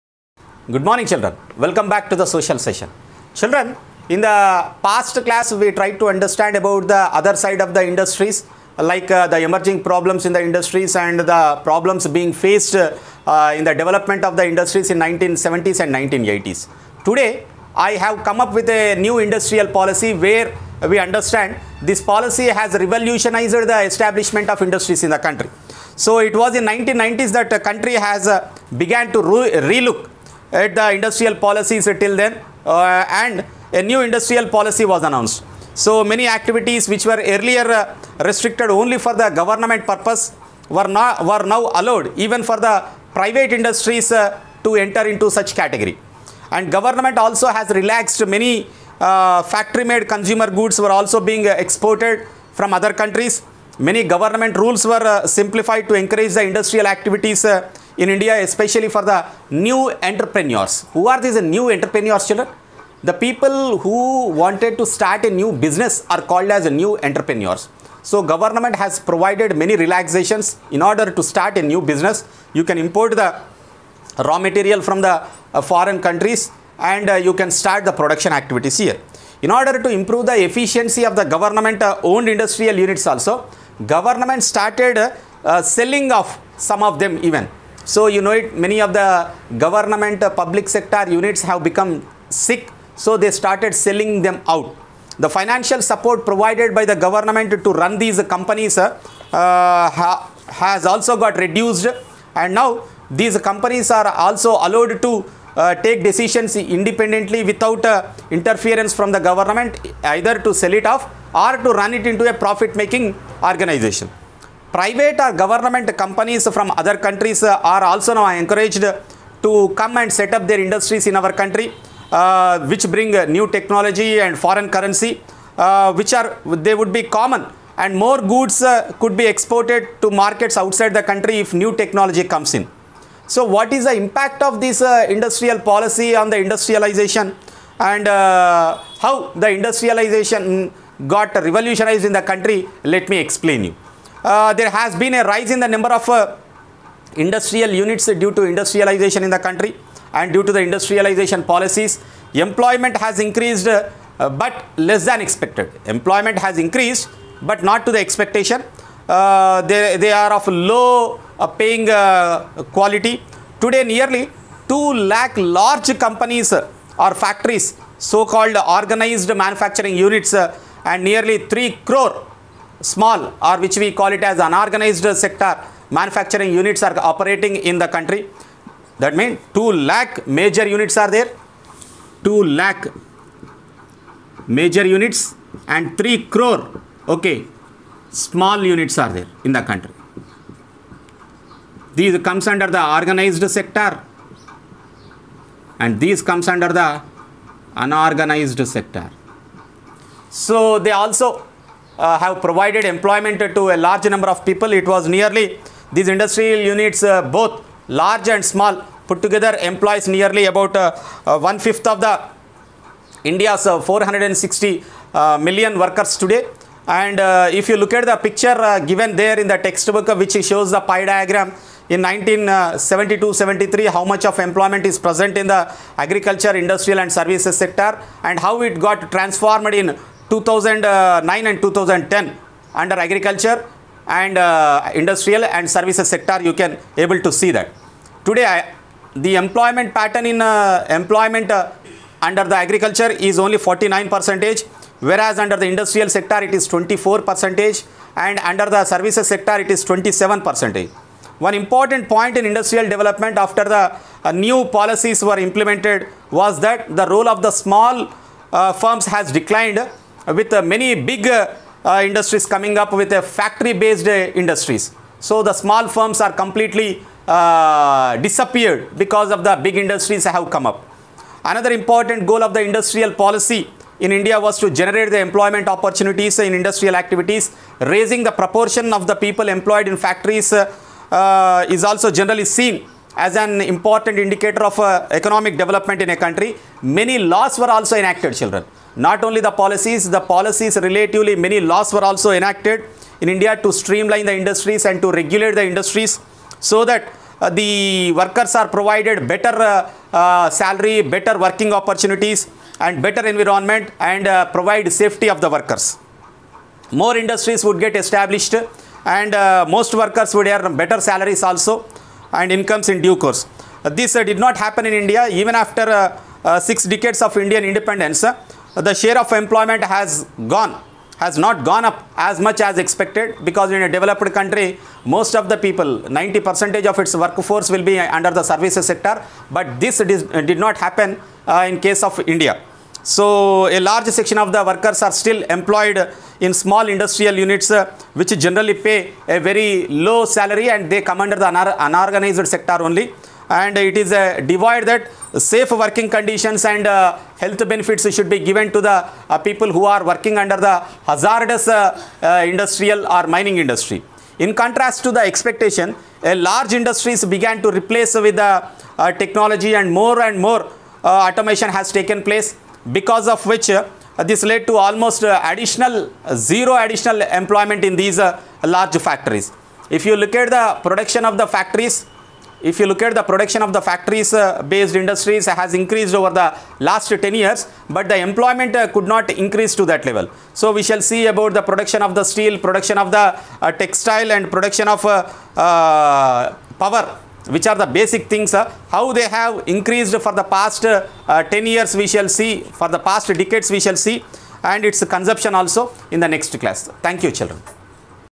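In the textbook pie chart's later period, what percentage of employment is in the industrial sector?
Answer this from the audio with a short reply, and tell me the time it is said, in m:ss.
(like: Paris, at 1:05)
24 percent, at 4:06.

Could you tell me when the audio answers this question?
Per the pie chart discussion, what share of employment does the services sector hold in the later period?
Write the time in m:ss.
4:09.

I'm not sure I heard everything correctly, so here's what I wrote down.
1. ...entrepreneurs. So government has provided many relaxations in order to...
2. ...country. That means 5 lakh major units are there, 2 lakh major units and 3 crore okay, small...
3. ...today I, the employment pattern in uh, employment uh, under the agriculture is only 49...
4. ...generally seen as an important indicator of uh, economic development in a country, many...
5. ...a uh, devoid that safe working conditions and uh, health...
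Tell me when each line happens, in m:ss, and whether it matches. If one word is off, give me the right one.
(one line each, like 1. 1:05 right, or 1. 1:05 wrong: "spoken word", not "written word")
1. 1:07 right
2. 2:57 wrong: "2", not "5"
3. 3:58 right
4. 4:42 right
5. 5:44 right.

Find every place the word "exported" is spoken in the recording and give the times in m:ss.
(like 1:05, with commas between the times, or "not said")
0:51, 2:09.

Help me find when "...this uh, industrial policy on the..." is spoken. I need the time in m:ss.
2:14.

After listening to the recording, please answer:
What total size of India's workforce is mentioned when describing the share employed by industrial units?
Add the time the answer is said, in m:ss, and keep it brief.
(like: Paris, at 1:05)
460 million, at 3:33.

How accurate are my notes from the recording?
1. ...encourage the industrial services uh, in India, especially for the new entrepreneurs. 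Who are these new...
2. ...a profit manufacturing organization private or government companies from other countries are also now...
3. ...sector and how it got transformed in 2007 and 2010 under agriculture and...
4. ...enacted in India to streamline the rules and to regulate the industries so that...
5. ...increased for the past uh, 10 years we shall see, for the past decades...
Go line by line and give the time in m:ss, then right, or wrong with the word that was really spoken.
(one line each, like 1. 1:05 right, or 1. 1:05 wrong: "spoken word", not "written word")
1. 0:55 wrong: "activities", not "services"
2. 1:52 wrong: "making", not "manufacturing"
3. 3:47 wrong: "2009", not "2007"
4. 4:52 wrong: "industries", not "rules"
5. 6:29 right.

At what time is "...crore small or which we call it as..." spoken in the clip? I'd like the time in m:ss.
2:51.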